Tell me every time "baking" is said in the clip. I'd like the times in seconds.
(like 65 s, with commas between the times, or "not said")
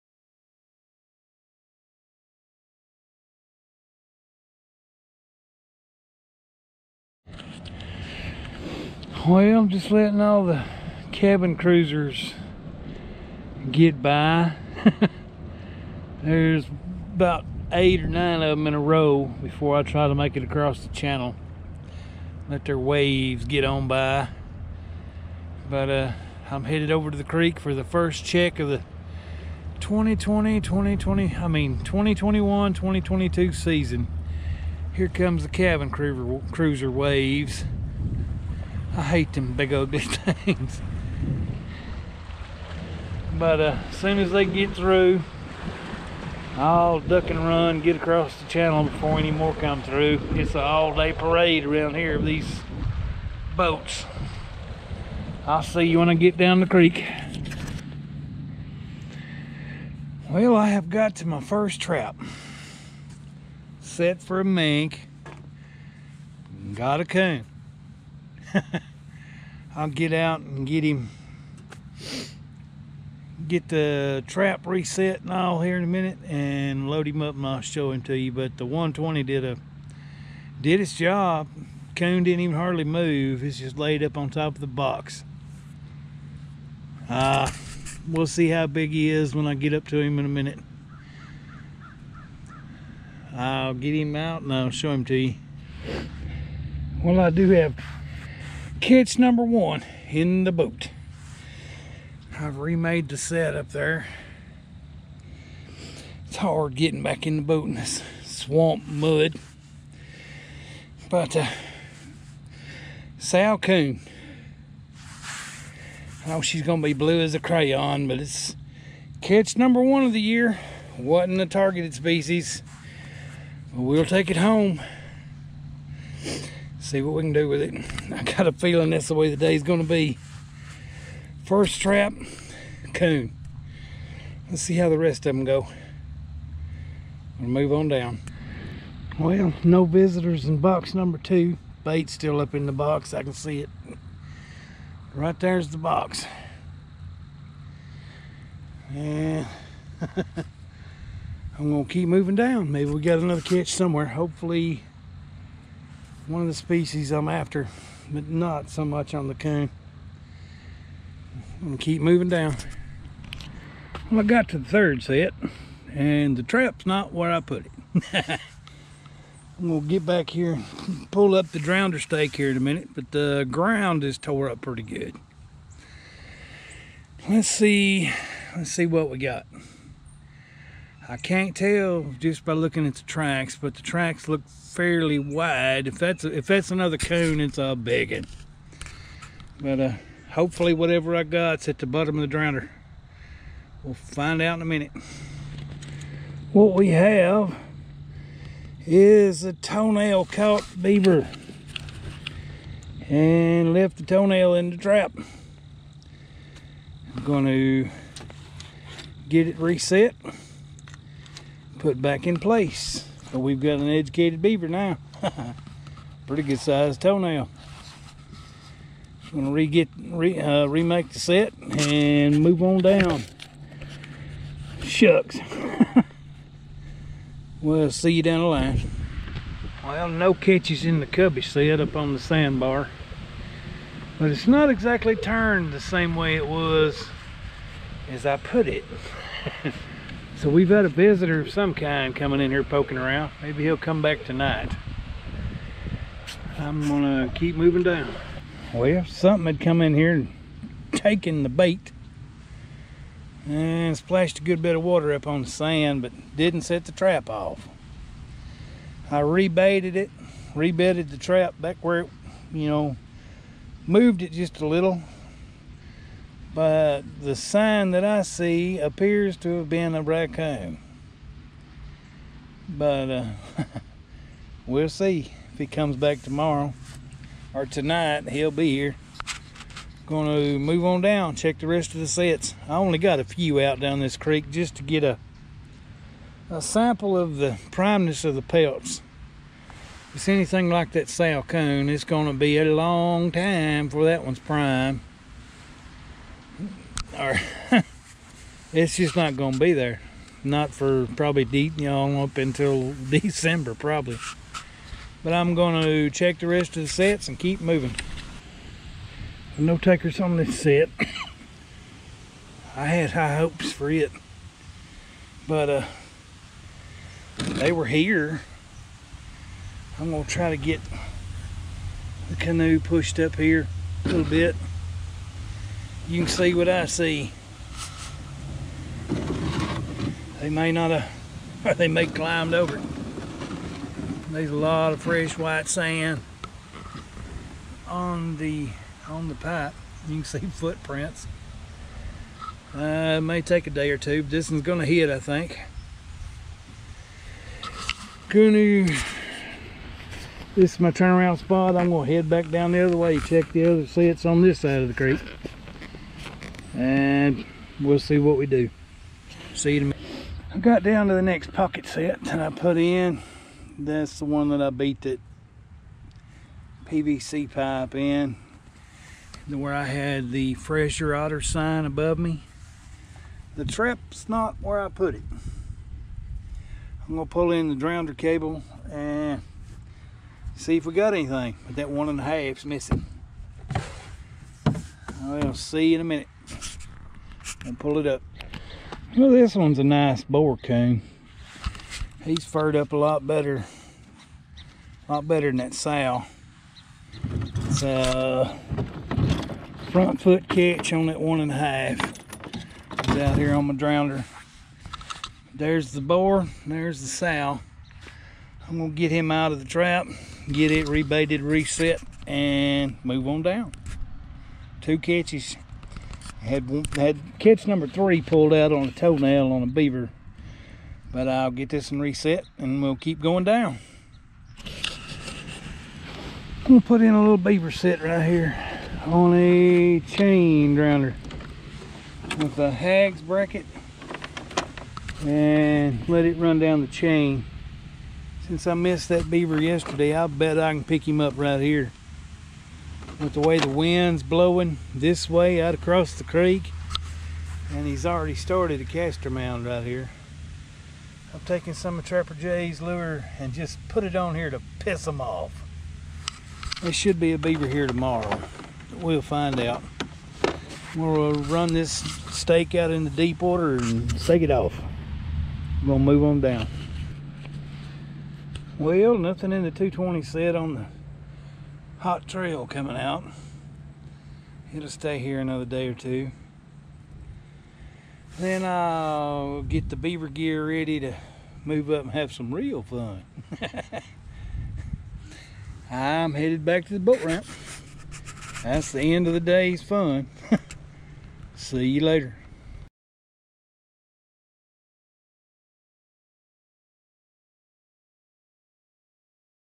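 not said.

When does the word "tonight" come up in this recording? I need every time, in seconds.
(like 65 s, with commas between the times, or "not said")
244 s, 277 s.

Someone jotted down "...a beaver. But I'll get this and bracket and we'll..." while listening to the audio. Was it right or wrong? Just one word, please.
wrong.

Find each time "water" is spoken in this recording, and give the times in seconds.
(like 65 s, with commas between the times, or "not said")
254 s, 463 s.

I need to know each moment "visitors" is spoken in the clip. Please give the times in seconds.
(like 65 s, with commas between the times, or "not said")
139 s, 240 s.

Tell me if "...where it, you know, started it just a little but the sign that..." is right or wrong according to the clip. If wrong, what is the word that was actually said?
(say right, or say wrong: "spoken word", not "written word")
wrong: "moved", not "started".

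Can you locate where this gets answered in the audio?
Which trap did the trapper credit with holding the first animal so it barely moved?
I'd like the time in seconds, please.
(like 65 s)
78 s.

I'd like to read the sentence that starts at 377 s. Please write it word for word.
I'm gonna pull in the drowner cable and see if we got anything.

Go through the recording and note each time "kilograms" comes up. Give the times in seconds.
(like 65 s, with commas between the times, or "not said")
not said.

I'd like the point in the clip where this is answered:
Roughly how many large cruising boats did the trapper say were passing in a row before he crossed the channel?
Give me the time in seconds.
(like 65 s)
17 s.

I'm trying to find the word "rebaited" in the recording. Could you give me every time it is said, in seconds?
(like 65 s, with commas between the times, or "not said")
259 s, 410 s.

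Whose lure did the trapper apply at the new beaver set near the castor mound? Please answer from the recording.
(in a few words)
Trapper Jay's.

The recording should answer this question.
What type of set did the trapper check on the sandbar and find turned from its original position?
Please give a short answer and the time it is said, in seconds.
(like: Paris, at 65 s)
cubby set, at 231 s.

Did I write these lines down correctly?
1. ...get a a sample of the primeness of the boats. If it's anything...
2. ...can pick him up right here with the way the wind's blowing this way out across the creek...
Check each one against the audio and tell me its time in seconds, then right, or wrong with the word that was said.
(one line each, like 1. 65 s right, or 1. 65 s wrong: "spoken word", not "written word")
1. 284 s wrong: "pelts", not "boats"
2. 440 s right.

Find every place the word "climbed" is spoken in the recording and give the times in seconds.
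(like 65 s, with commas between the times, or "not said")
332 s.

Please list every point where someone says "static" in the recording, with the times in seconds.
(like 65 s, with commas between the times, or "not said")
not said.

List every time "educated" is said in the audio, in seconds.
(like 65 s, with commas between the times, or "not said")
213 s.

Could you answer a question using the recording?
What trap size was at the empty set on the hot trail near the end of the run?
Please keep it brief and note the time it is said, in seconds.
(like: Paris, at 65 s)
220, at 469 s.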